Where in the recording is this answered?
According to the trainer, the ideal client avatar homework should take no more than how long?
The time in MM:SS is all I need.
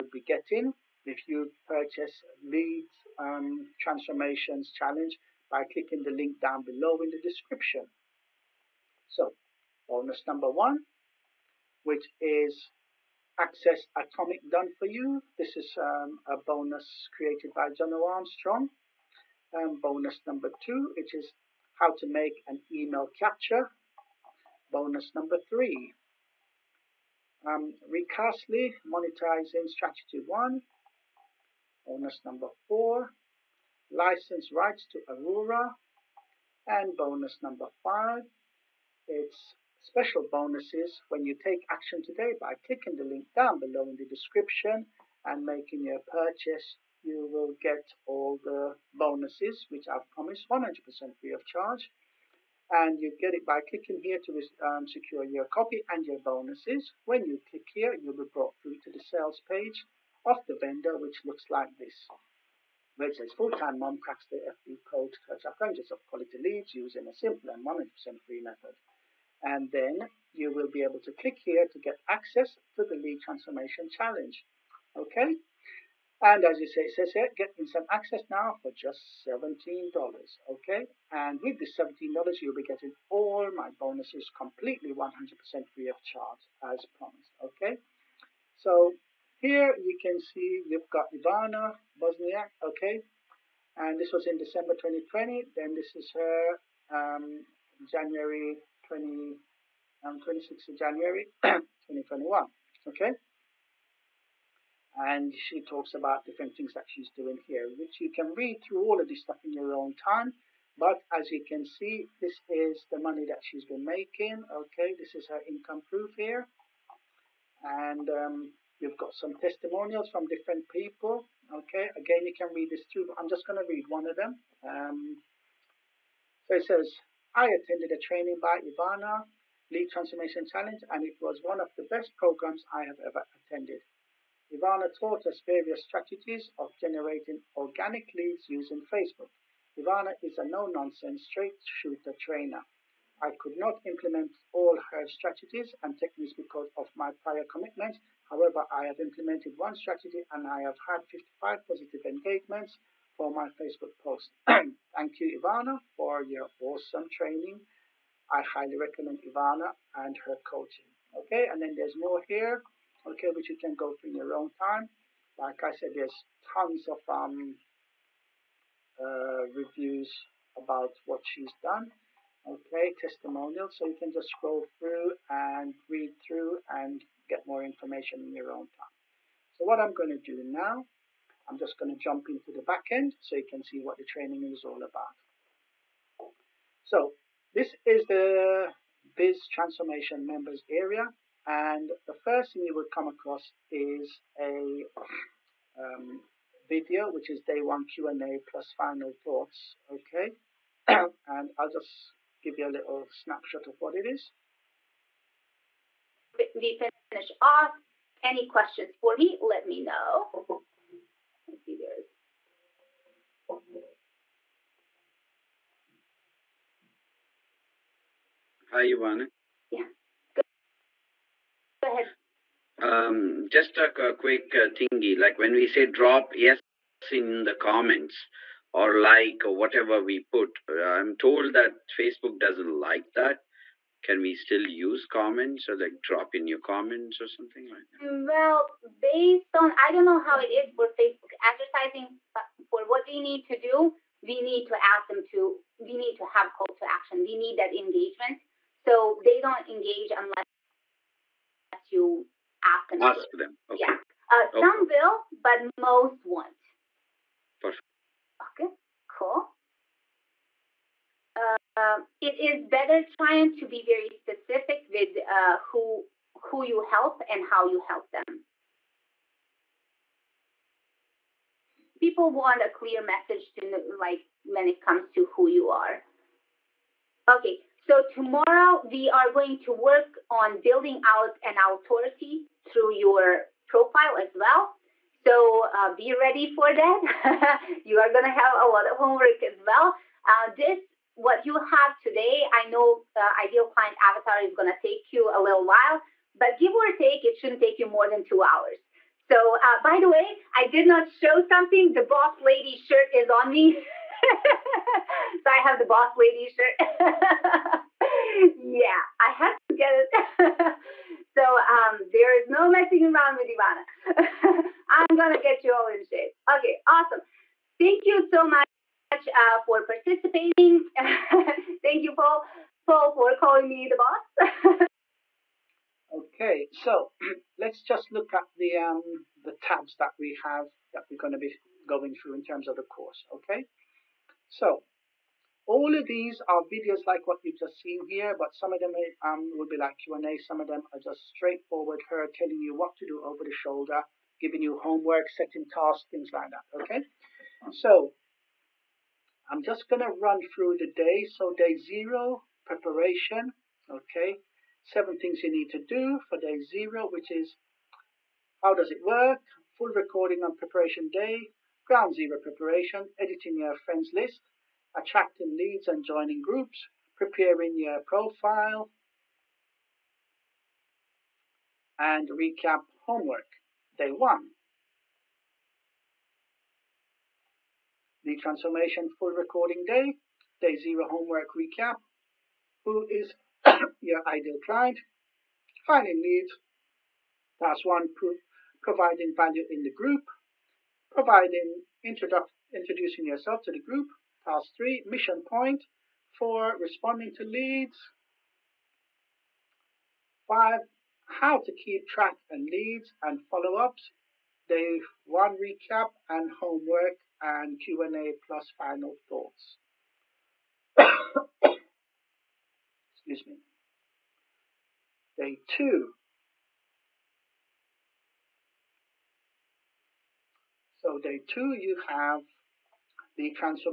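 04:58.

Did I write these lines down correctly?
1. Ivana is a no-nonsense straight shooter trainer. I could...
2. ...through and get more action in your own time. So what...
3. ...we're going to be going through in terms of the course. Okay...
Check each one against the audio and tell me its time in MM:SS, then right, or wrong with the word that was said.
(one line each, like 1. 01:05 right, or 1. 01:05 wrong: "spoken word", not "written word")
1. 02:19 right
2. 02:56 wrong: "information", not "action"
3. 05:31 right.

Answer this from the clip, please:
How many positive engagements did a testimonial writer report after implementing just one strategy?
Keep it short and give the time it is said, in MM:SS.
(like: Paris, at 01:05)
55, at 02:31.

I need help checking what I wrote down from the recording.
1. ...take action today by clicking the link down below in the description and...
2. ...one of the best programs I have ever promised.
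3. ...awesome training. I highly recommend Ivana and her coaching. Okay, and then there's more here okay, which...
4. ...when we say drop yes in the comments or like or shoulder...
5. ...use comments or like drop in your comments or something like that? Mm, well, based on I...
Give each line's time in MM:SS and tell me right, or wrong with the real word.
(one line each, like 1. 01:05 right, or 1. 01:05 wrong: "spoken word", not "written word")
1. 00:41 right
2. 02:11 wrong: "attended", not "promised"
3. 02:36 right
4. 03:45 wrong: "whatever", not "shoulder"
5. 03:54 right.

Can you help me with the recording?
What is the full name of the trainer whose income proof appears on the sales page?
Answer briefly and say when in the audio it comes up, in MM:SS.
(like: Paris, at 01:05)
Ivana Bosniak, at 01:31.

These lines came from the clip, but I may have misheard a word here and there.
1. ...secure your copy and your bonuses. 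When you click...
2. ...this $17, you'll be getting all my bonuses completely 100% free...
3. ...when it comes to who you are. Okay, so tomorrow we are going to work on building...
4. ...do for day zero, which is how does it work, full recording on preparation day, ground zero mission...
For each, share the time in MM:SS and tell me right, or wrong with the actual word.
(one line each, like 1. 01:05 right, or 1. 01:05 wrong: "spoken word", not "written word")
1. 00:54 right
2. 01:21 right
3. 04:34 right
4. 05:55 wrong: "preparation", not "mission".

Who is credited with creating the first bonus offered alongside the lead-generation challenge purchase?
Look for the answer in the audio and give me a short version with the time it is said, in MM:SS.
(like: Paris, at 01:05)
John Armstrong, at 00:17.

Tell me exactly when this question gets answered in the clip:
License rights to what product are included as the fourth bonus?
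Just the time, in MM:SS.
00:35.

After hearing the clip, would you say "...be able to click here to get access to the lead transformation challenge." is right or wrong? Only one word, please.
right.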